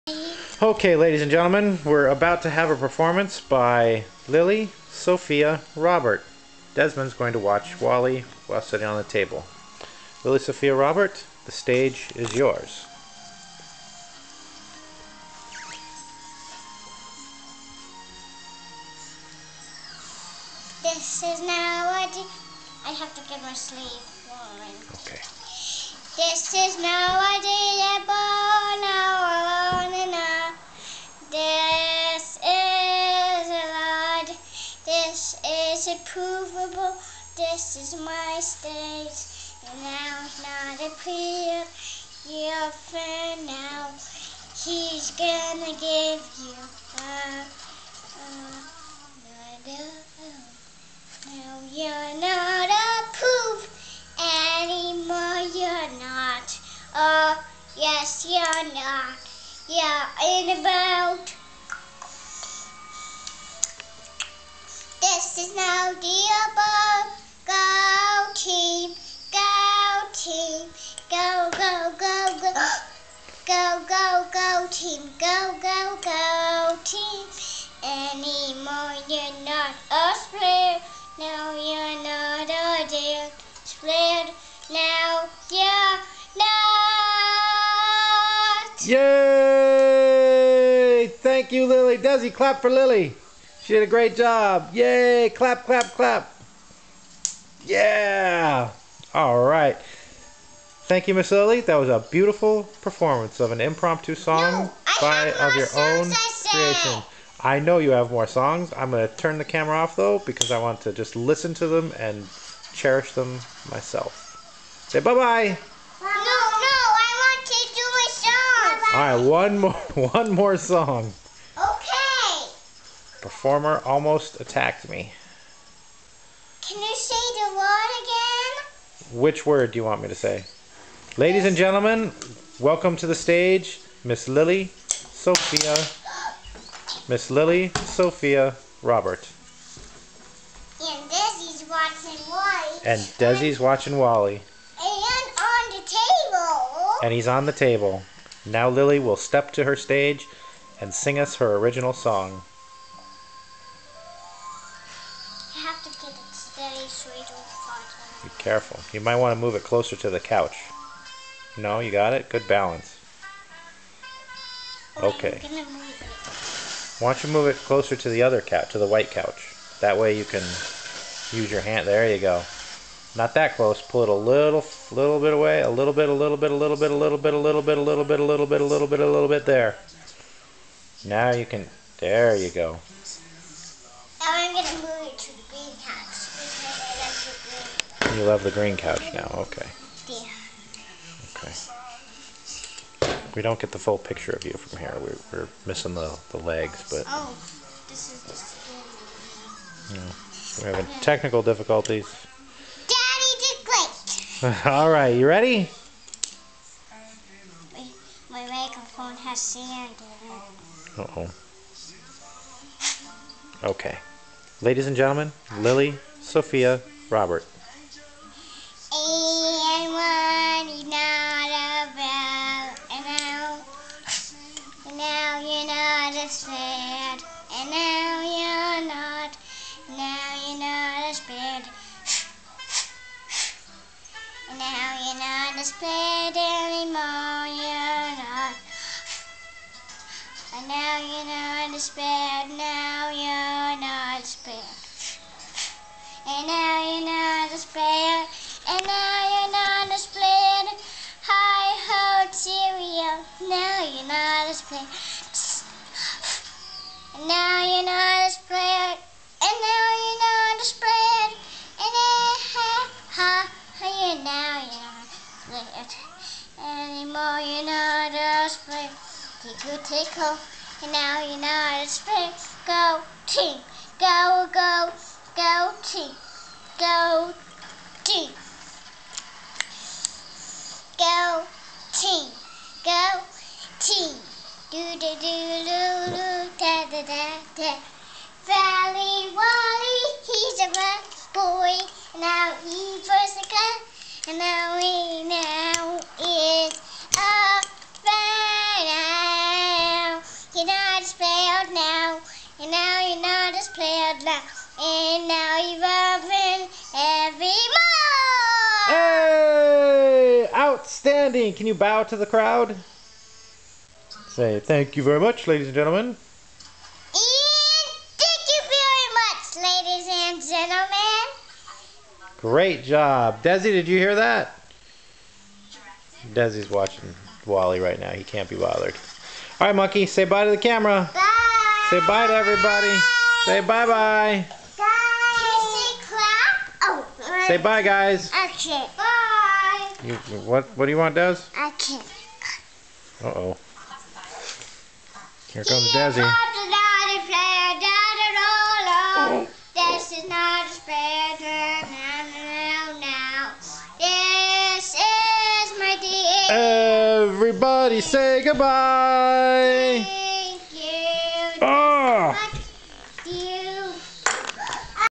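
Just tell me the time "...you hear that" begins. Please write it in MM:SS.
05:23.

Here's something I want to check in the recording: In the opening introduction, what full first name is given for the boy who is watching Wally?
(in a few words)
Desmond.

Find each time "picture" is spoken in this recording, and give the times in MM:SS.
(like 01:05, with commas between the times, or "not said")
03:13.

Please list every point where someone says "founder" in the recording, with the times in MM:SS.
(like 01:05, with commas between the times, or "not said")
not said.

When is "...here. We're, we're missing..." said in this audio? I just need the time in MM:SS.
03:14.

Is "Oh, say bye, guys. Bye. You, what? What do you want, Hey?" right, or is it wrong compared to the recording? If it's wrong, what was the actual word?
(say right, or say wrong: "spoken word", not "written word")
wrong: "Des", not "Hey".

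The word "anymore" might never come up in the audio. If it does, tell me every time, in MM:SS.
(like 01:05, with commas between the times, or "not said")
00:54, 01:17.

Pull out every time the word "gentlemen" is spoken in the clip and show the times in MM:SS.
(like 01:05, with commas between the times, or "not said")
00:01, 02:11, 03:34, 05:15, 05:20.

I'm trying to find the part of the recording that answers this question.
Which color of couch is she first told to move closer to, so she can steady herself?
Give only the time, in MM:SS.
02:48.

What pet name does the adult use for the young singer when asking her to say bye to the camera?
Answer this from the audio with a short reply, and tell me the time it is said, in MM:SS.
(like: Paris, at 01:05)
Monkey, at 05:29.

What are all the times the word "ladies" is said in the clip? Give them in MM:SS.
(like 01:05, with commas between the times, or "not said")
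00:00, 02:11, 03:34, 05:15, 05:19.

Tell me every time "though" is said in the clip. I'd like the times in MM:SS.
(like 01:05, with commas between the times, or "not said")
01:49.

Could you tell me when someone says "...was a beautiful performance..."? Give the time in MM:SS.
01:41.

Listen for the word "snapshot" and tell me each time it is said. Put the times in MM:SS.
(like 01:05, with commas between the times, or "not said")
not said.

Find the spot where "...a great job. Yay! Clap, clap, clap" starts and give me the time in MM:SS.
01:33.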